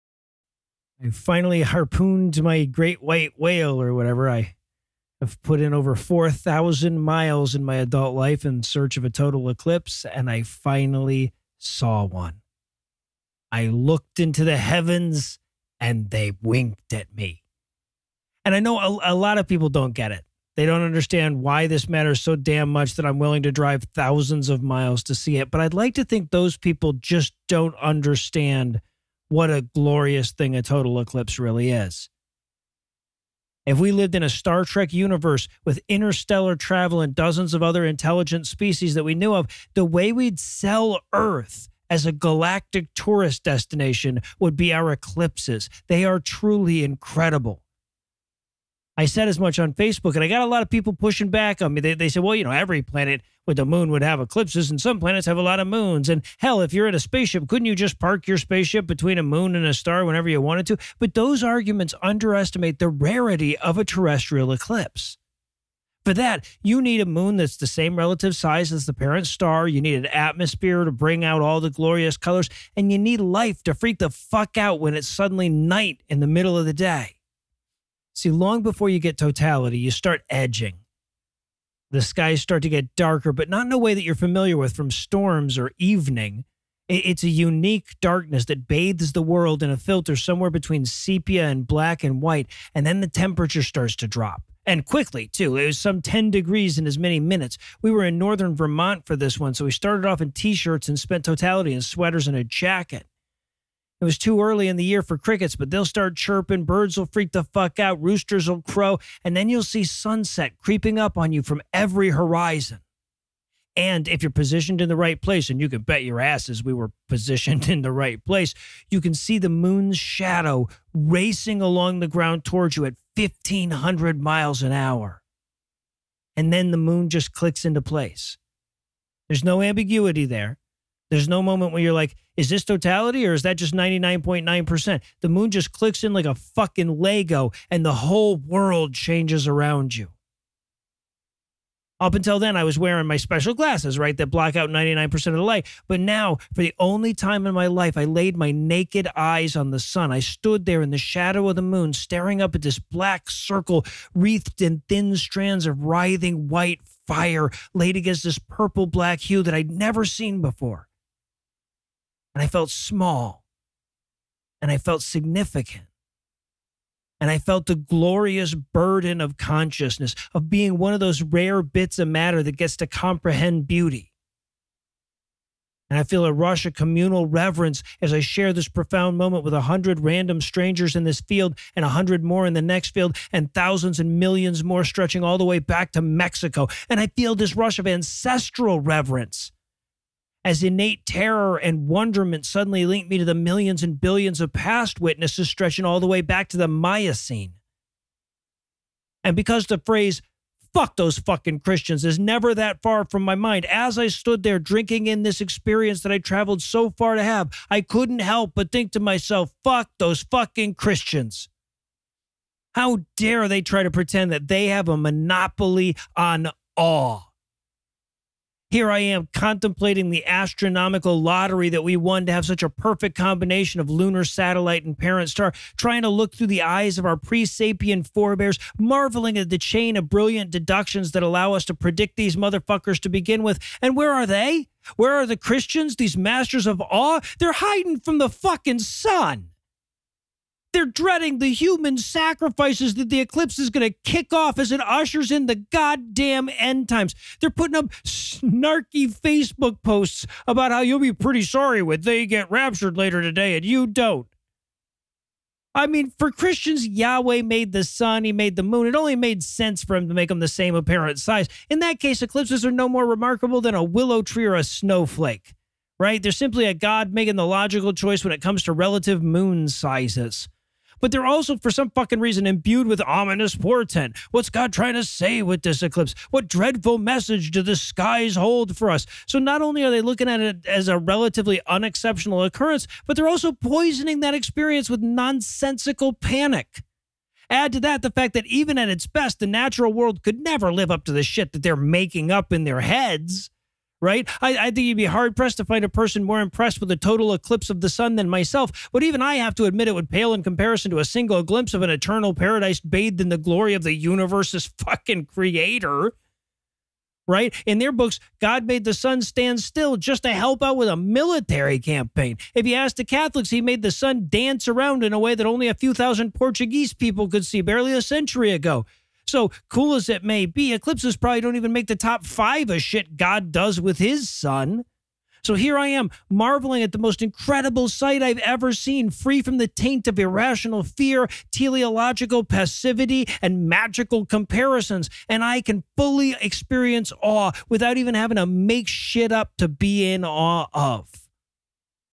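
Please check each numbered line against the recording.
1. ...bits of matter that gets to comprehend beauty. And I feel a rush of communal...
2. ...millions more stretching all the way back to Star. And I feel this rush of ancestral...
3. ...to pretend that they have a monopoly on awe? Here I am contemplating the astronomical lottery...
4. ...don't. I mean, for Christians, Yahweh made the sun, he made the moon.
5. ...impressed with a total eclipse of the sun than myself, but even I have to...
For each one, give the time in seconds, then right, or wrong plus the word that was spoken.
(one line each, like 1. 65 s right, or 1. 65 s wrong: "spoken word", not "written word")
1. 171 s right
2. 184 s wrong: "Mexico", not "Star"
3. 213 s right
4. 253 s right
5. 296 s right.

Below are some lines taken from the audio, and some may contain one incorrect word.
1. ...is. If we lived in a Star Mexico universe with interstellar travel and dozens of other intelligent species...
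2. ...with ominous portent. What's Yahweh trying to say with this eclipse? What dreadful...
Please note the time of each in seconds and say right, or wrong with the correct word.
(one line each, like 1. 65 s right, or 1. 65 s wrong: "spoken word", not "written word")
1. 31 s wrong: "Trek", not "Mexico"
2. 272 s wrong: "God", not "Yahweh".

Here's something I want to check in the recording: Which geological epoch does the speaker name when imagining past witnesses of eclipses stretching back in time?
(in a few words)
Miocene.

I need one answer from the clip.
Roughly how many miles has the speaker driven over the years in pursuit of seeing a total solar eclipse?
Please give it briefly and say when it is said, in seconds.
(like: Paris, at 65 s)
4,000, at 5 s.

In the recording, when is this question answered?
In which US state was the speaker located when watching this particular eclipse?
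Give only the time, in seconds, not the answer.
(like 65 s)
98 s.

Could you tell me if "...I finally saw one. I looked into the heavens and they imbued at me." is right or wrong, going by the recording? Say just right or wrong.
wrong.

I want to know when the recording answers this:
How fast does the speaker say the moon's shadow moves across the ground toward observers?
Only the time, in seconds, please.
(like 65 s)
123 s.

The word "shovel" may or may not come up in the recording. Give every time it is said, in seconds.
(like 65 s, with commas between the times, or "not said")
not said.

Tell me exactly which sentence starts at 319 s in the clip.
So cool as it may be, eclipses probably don't even make the top five of shit God does with his son.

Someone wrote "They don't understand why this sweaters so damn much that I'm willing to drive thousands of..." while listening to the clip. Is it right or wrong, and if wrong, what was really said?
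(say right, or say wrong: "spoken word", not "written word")
wrong: "matters", not "sweaters".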